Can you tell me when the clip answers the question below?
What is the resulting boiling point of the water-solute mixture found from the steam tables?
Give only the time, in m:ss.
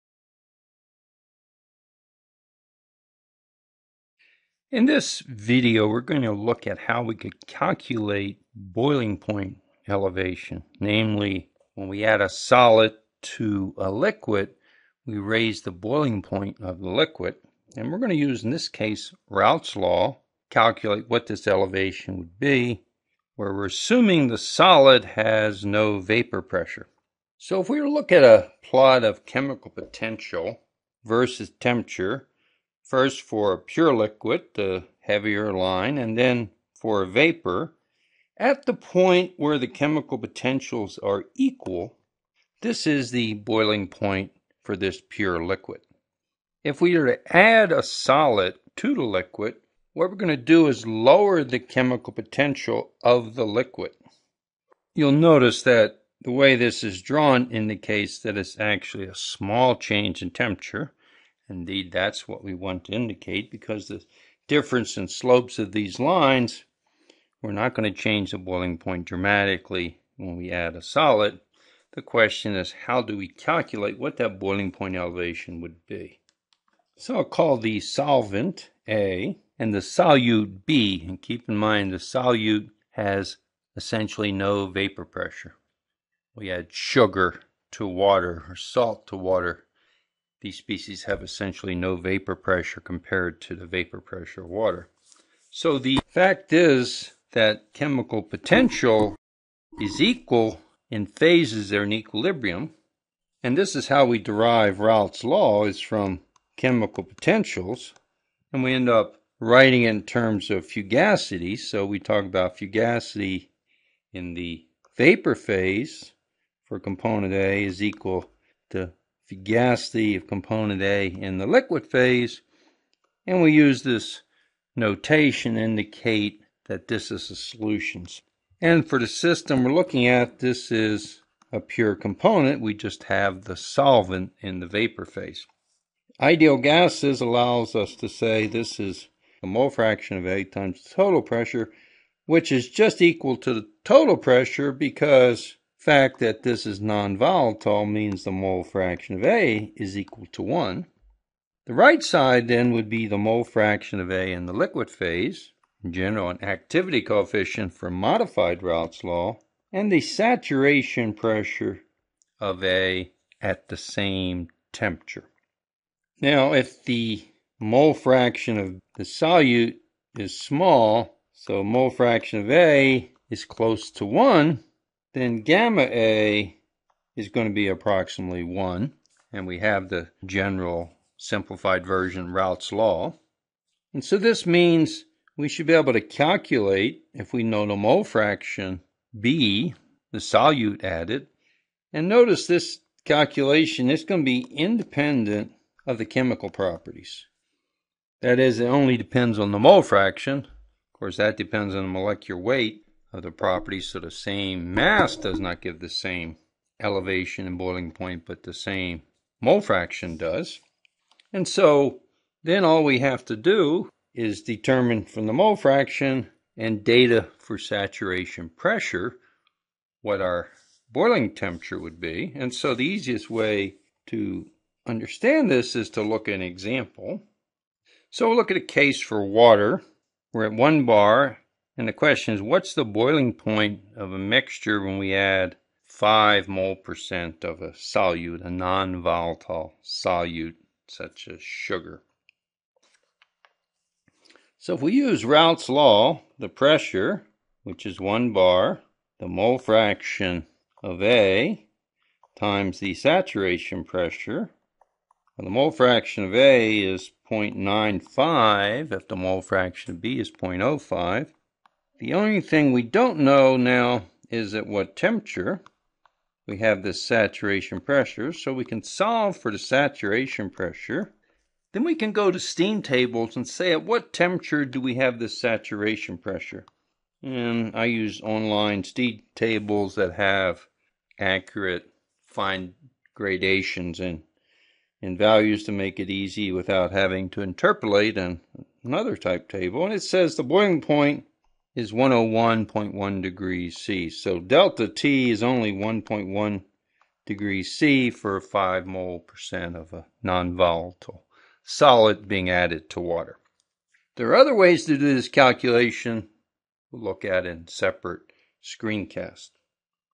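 4:51.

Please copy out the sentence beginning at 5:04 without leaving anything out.
There are other ways to do this calculation.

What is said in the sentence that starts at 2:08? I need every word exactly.
And for the system we're looking at, this is a pure component.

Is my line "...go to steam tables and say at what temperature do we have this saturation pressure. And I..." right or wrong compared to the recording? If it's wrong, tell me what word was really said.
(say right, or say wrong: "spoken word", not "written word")
right.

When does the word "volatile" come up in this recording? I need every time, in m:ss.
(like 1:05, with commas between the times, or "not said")
2:26, 3:58, 5:00.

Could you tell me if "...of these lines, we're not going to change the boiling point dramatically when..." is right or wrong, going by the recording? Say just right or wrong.
right.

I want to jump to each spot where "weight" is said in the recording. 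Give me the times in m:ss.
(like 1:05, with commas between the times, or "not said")
3:22.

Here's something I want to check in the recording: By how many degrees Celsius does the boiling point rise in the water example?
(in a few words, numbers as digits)
1.1.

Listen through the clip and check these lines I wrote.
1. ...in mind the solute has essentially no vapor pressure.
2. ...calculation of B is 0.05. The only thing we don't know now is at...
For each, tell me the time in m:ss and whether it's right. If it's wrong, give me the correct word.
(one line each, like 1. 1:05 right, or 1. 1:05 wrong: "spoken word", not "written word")
1. 1:21 right
2. 4:19 wrong: "fraction", not "calculation".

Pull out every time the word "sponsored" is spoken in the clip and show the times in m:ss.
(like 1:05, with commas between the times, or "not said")
not said.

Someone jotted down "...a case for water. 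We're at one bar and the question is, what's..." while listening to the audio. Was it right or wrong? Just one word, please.
right.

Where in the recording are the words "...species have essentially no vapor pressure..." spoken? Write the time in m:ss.
1:30.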